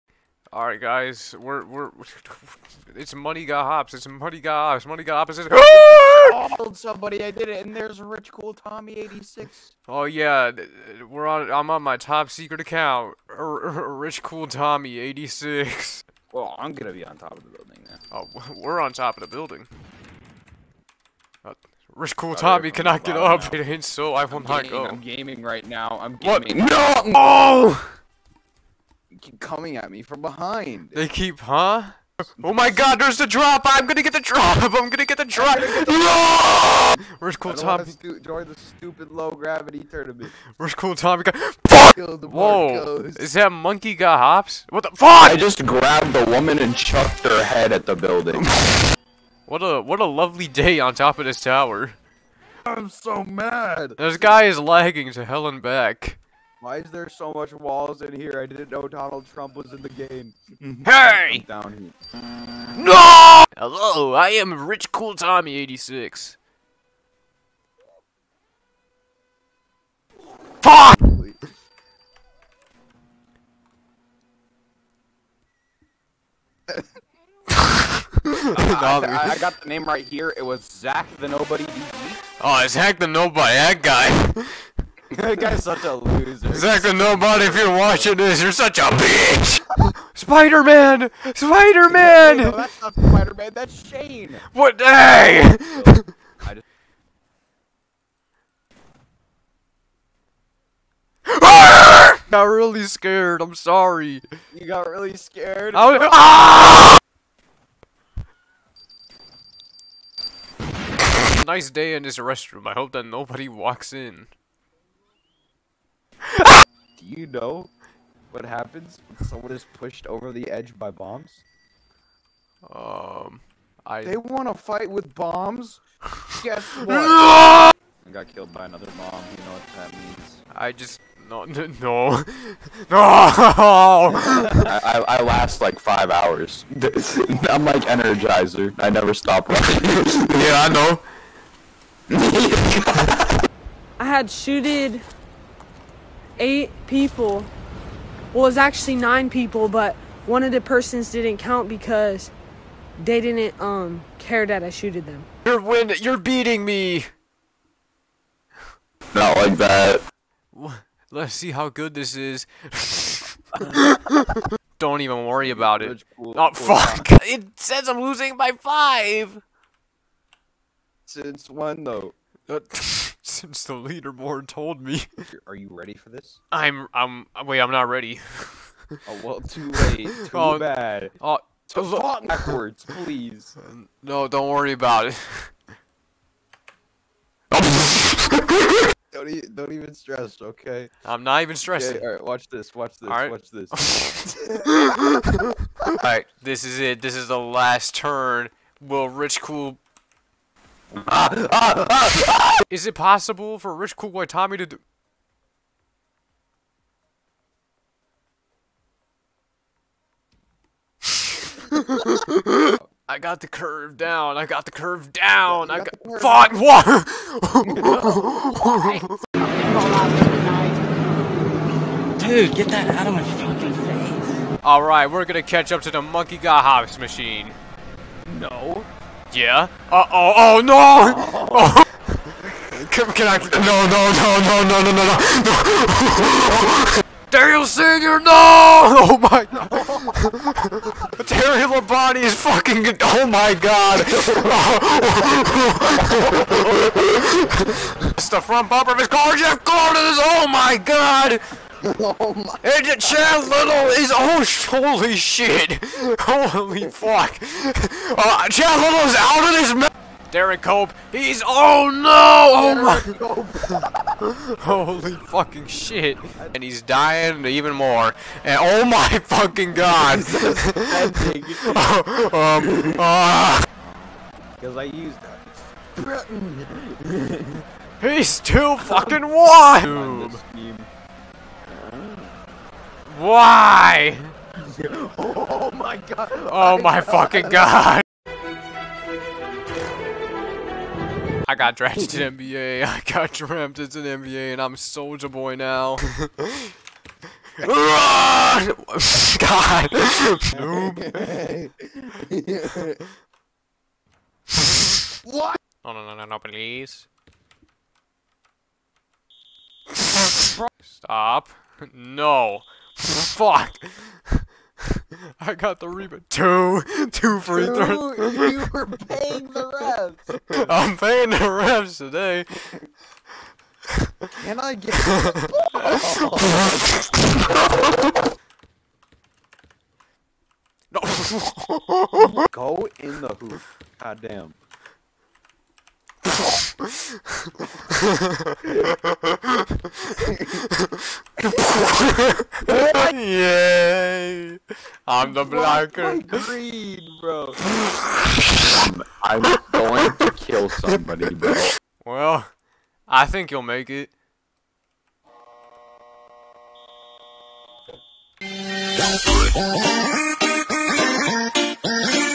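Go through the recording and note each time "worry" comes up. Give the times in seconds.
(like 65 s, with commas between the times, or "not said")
165 s, 184 s.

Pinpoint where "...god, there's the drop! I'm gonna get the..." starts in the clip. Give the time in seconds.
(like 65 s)
32 s.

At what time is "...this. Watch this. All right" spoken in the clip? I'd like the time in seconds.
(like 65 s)
192 s.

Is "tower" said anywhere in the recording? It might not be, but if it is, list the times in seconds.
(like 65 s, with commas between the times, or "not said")
51 s.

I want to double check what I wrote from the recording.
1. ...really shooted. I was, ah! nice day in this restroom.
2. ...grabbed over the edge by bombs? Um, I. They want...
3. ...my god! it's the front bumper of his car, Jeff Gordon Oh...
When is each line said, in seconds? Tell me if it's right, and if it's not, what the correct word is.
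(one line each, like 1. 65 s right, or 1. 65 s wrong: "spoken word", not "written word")
1. 104 s wrong: "scared", not "shooted"
2. 119 s wrong: "pushed", not "grabbed"
3. 243 s right.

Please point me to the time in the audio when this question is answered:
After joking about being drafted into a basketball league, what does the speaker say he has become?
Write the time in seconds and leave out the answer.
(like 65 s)
294 s.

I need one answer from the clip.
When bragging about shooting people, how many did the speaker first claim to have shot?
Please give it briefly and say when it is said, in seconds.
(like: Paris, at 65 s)
8, at 146 s.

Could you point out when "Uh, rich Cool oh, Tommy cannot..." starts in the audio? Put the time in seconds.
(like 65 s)
21 s.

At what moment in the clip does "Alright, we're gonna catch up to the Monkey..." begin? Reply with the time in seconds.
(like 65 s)
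224 s.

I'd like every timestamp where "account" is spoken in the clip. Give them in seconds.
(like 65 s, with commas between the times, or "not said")
12 s.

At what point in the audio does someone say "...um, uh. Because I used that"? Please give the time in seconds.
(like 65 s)
272 s.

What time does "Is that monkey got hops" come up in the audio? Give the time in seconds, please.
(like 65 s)
43 s.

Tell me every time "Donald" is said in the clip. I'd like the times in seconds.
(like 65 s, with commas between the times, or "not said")
58 s.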